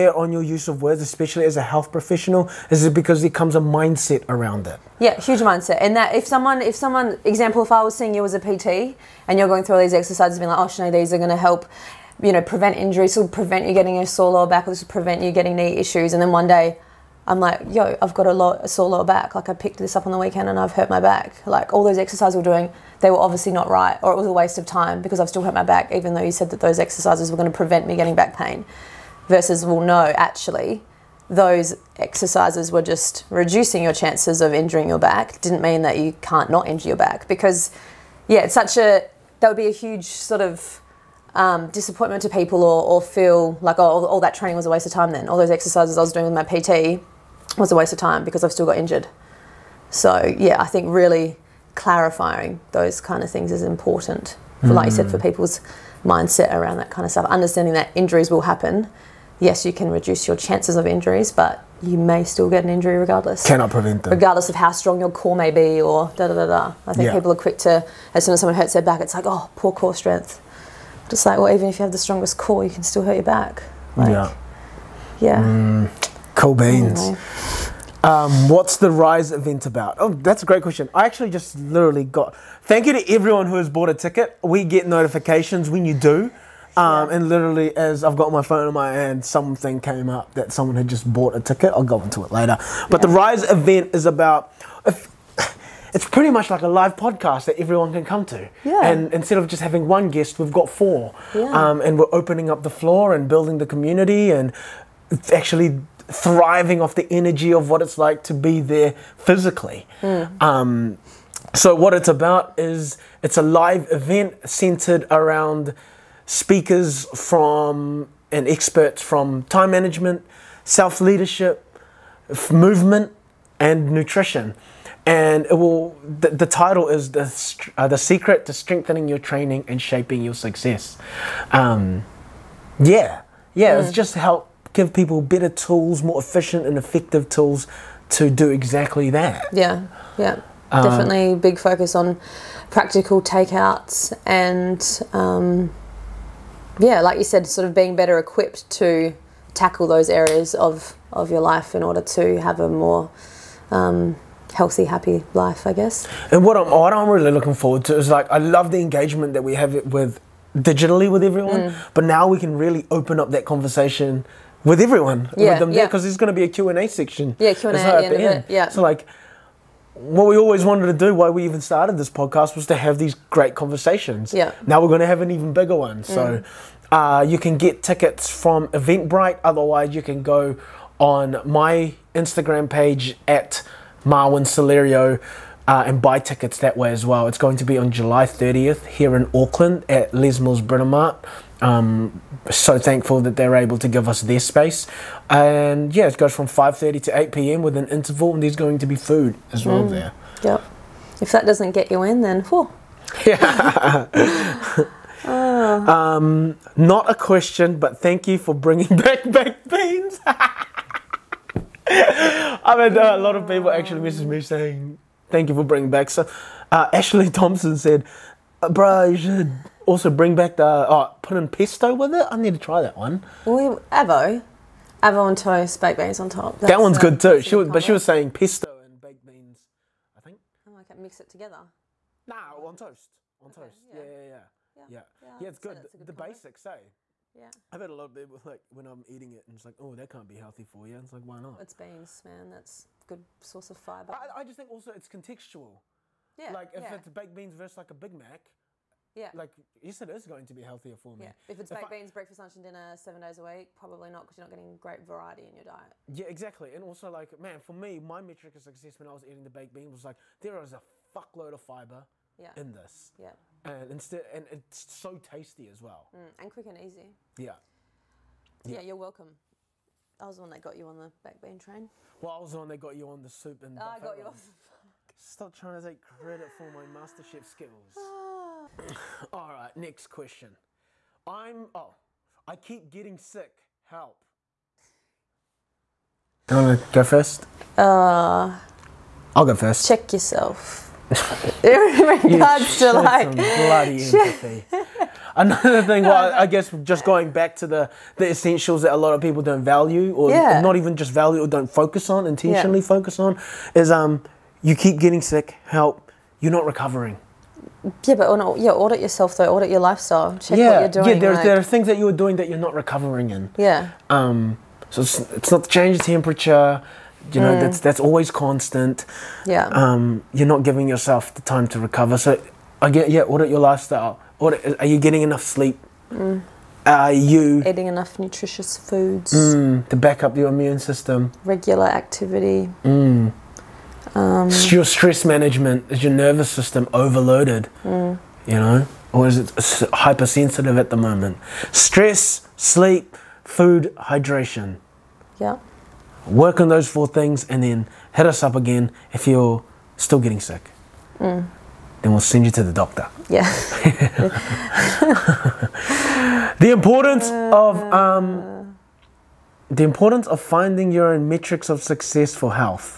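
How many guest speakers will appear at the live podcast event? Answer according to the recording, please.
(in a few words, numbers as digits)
4.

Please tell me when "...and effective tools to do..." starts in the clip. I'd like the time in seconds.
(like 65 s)
136 s.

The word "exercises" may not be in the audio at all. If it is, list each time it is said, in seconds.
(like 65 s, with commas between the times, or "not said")
9 s, 21 s, 26 s, 31 s, 45 s.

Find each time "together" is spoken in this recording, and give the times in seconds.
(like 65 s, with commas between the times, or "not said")
231 s.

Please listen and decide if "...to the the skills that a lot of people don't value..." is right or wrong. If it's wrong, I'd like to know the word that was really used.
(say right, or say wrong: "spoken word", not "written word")
wrong: "essentials", not "skills".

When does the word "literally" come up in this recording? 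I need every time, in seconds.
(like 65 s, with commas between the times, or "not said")
81 s, 87 s.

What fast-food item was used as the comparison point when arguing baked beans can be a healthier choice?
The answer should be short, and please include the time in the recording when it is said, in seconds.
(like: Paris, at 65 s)
Big Mac, at 247 s.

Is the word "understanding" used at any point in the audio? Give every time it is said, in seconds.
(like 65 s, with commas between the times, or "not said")
57 s.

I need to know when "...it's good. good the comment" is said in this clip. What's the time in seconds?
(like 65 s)
235 s.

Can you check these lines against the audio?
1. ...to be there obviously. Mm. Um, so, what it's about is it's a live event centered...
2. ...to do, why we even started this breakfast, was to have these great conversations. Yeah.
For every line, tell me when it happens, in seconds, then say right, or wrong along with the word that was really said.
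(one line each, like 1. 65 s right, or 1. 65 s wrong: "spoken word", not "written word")
1. 108 s wrong: "physically", not "obviously"
2. 170 s wrong: "podcast", not "breakfast".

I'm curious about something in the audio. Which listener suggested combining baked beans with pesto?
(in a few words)
Ashley Thompson.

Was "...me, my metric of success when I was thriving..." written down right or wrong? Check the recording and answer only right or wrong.
wrong.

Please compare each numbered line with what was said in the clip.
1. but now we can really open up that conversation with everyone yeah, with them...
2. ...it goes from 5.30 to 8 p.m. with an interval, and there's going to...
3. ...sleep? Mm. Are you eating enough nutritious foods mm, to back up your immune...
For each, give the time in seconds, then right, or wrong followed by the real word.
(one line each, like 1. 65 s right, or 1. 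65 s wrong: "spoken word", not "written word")
1. 161 s right
2. 196 s right
3. 325 s right.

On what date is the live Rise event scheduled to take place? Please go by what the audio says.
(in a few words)
July 30th.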